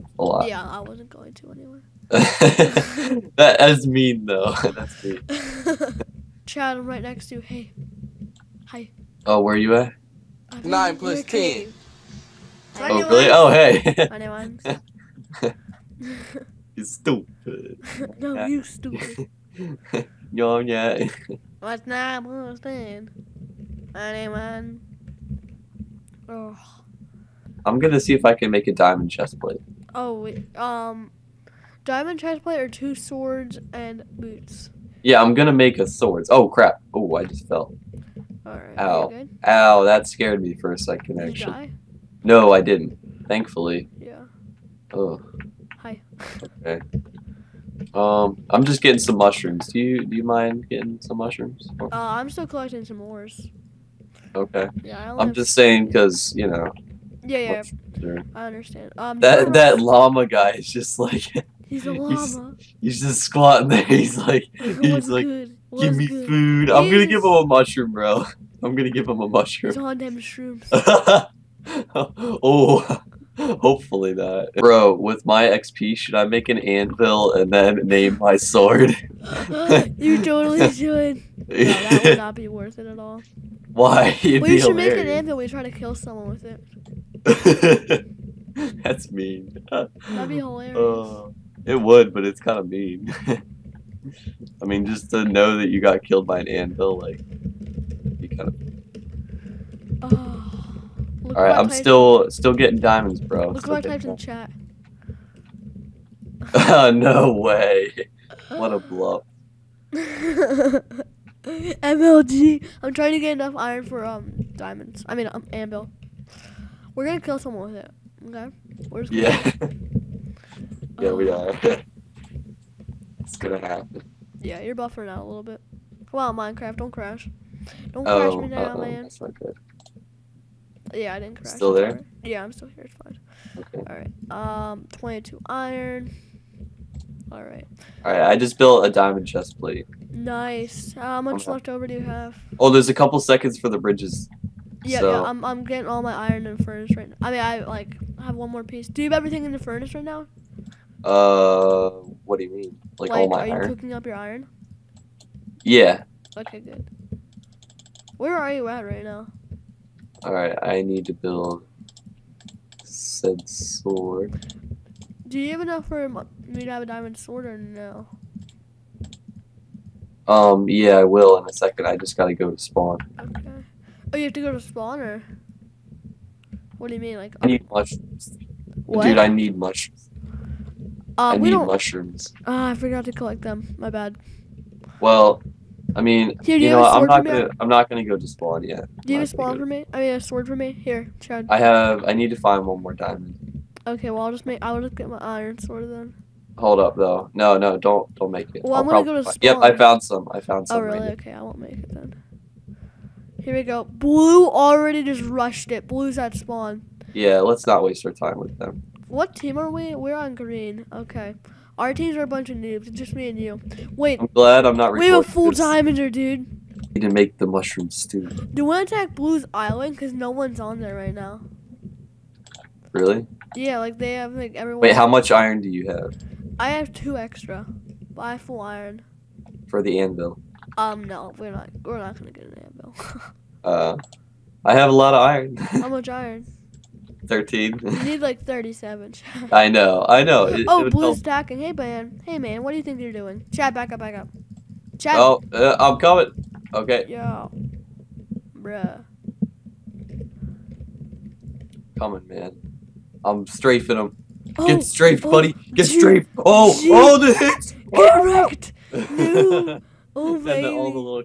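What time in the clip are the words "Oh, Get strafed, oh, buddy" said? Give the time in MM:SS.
04:14.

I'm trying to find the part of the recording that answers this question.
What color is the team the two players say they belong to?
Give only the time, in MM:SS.
03:30.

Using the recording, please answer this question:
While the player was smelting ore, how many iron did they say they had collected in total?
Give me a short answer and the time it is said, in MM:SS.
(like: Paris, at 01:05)
22, at 02:14.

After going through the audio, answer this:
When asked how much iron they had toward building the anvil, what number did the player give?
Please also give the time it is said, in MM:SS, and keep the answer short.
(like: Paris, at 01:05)
13, at 03:57.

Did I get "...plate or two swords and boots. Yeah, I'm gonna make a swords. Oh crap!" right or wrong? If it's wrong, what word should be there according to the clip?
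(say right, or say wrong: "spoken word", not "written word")
right.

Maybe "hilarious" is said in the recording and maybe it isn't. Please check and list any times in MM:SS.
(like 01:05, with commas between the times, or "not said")
01:24, 01:30.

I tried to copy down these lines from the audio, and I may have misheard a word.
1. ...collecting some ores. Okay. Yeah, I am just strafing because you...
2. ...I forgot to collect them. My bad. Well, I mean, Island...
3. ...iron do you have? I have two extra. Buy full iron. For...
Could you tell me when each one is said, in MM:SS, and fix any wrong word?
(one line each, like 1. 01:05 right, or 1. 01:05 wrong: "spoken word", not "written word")
1. 00:52 wrong: "saying", not "strafing"
2. 03:02 wrong: "Here", not "Island"
3. 03:45 right.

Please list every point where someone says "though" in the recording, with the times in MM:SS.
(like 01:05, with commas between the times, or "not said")
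00:04, 03:16.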